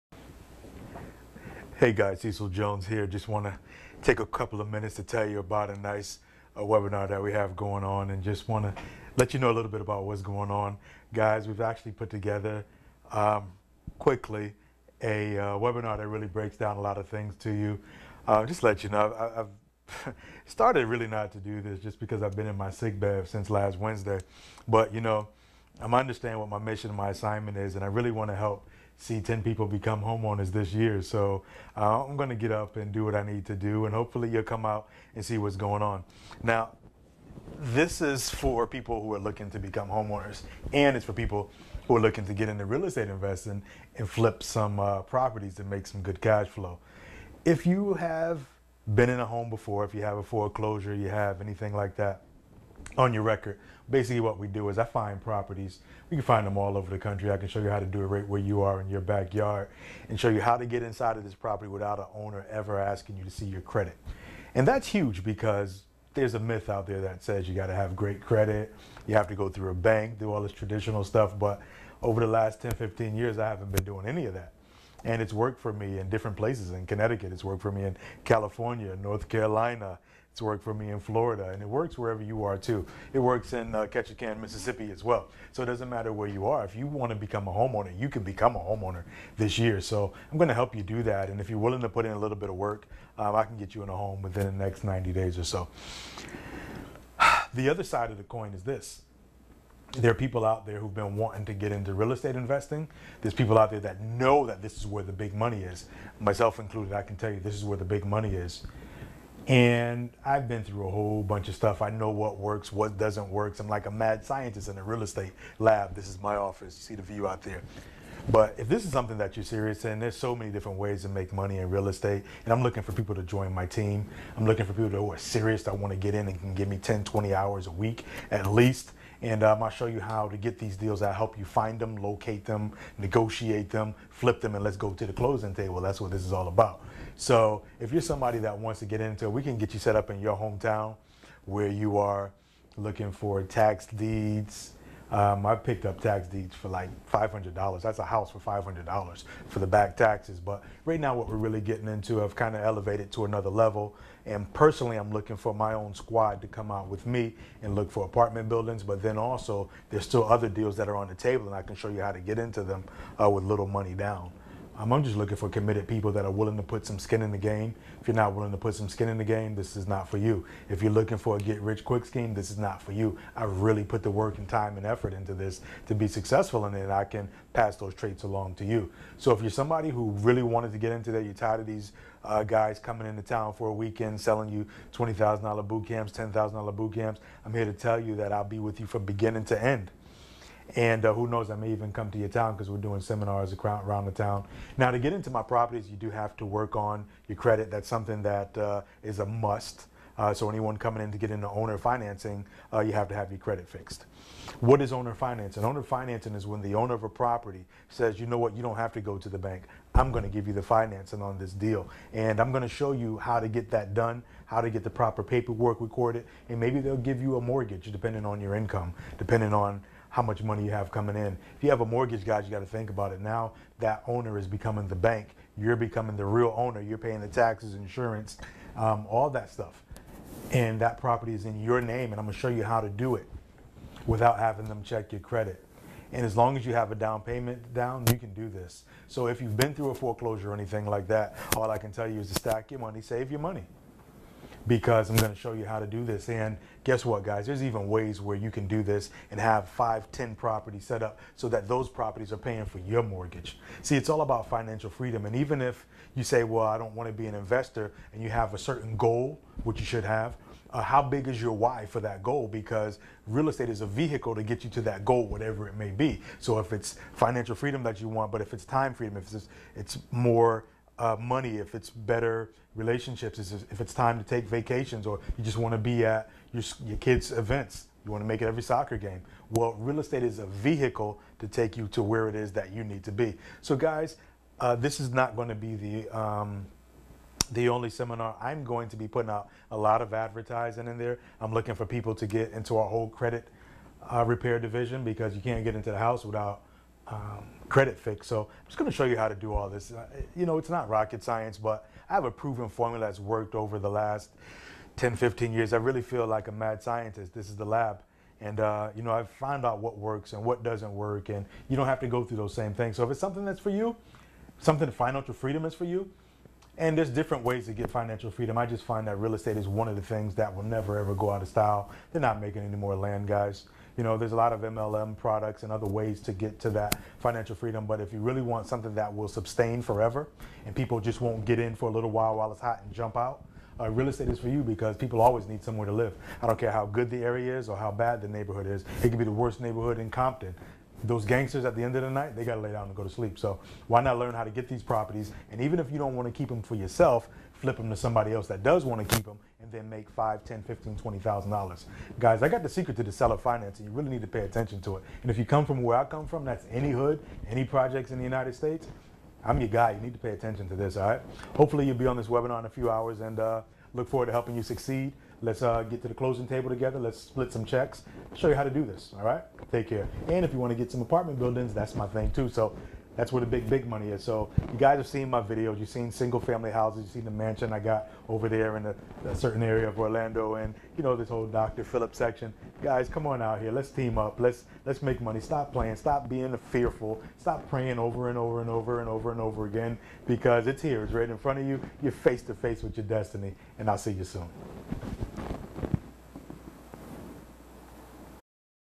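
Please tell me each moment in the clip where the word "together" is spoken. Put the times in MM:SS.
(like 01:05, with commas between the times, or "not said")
00:12, 06:06.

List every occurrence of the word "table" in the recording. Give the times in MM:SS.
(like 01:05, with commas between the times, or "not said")
02:15, 02:41, 06:06.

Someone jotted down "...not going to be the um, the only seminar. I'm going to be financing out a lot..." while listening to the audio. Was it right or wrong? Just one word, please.
wrong.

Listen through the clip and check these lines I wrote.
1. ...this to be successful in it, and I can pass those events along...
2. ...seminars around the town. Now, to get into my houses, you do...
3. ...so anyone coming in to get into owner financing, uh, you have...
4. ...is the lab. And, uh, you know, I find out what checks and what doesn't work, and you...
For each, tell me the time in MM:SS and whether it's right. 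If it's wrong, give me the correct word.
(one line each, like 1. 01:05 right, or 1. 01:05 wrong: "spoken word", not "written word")
1. 02:55 wrong: "traits", not "events"
2. 03:13 wrong: "properties", not "houses"
3. 03:20 right
4. 05:07 wrong: "works", not "checks".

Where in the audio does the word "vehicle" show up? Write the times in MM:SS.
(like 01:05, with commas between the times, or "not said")
04:23, 04:40.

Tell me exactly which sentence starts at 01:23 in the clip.
It works in uh, Ketchikan, Mississippi as well.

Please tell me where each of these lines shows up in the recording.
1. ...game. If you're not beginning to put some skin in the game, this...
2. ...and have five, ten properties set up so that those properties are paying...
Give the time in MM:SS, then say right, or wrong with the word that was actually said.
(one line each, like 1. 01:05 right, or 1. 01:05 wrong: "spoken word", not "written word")
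1. 02:47 wrong: "willing", not "beginning"
2. 04:09 right.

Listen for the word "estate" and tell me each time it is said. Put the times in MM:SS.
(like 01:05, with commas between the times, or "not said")
00:42, 01:42, 01:55, 02:01, 04:23, 04:39, 05:19, 05:34.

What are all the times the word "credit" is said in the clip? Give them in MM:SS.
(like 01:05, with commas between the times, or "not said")
01:03, 01:08, 03:17, 03:23, 03:55, 04:53, 04:57.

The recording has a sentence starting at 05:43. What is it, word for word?
So why not learn how to get these properties?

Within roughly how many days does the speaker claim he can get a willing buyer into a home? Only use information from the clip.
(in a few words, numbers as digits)
90 days.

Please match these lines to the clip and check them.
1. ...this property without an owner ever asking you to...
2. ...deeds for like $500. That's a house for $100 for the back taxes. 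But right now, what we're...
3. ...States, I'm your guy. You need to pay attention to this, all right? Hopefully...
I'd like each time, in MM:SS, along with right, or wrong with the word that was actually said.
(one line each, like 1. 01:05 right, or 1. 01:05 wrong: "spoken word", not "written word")
1. 01:01 right
2. 02:26 wrong: "500", not "100"
3. 05:58 right.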